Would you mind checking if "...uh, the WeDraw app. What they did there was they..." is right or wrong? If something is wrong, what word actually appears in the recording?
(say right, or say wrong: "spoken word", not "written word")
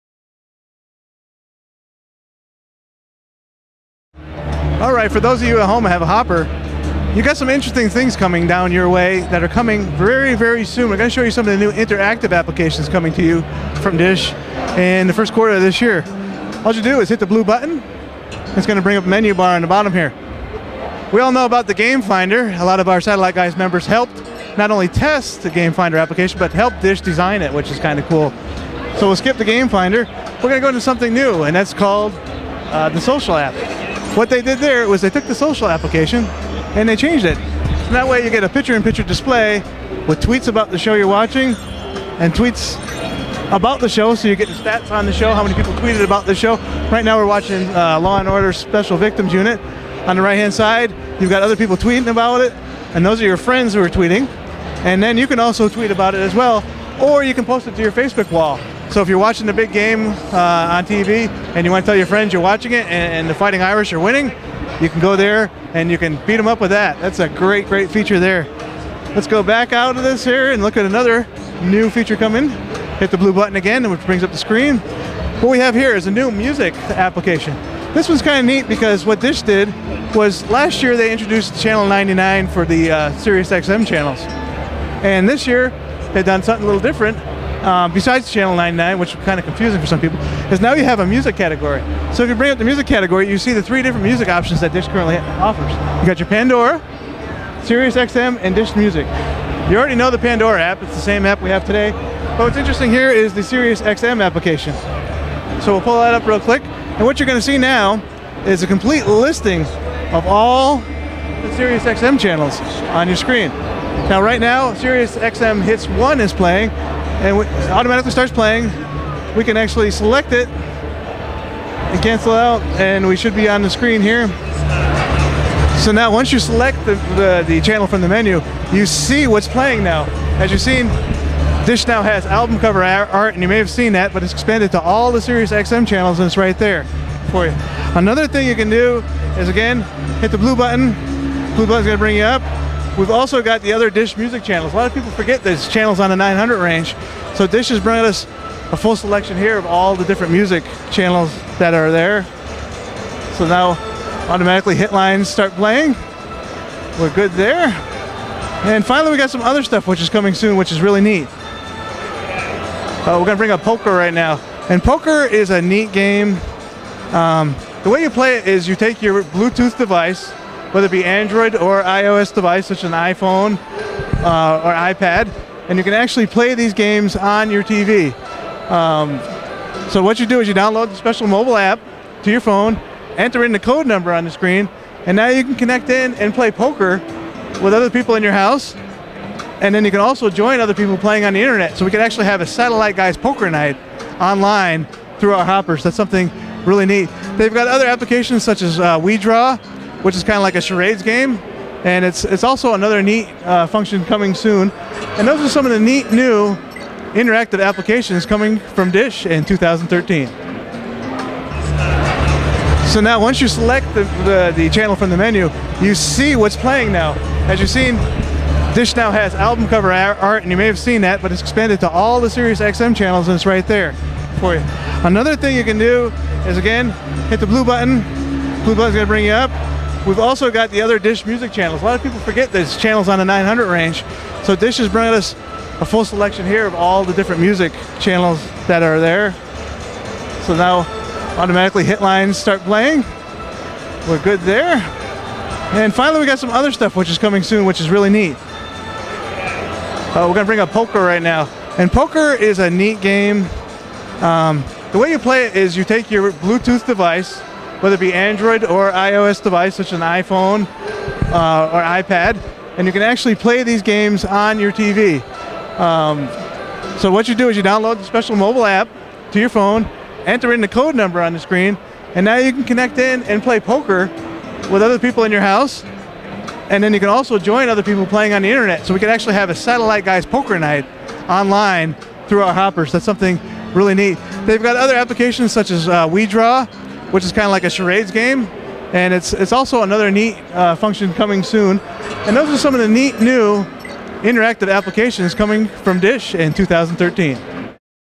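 wrong: "Social", not "WeDraw".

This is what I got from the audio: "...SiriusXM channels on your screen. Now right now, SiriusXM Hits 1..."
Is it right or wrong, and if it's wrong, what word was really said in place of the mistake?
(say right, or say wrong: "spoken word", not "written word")
right.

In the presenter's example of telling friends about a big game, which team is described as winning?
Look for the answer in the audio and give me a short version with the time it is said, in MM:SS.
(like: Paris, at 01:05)
Fighting Irish, at 01:03.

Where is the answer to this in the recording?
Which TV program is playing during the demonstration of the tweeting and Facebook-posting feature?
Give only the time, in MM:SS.
00:48.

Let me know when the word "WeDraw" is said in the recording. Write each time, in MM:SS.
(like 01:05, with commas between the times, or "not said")
03:18, 04:46.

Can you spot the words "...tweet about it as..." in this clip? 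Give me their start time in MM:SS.
00:55.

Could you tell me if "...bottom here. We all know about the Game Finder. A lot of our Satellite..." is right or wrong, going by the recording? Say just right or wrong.
right.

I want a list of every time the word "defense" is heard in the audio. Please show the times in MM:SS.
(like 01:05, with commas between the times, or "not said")
not said.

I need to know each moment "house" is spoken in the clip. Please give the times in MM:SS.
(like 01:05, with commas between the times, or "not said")
03:08, 04:35.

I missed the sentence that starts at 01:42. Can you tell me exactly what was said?
But what's interesting here is the SiriusXM application.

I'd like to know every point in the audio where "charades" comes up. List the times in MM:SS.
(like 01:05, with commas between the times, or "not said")
03:20, 04:47.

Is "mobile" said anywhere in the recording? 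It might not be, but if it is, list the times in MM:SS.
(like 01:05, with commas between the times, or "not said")
03:01, 04:28.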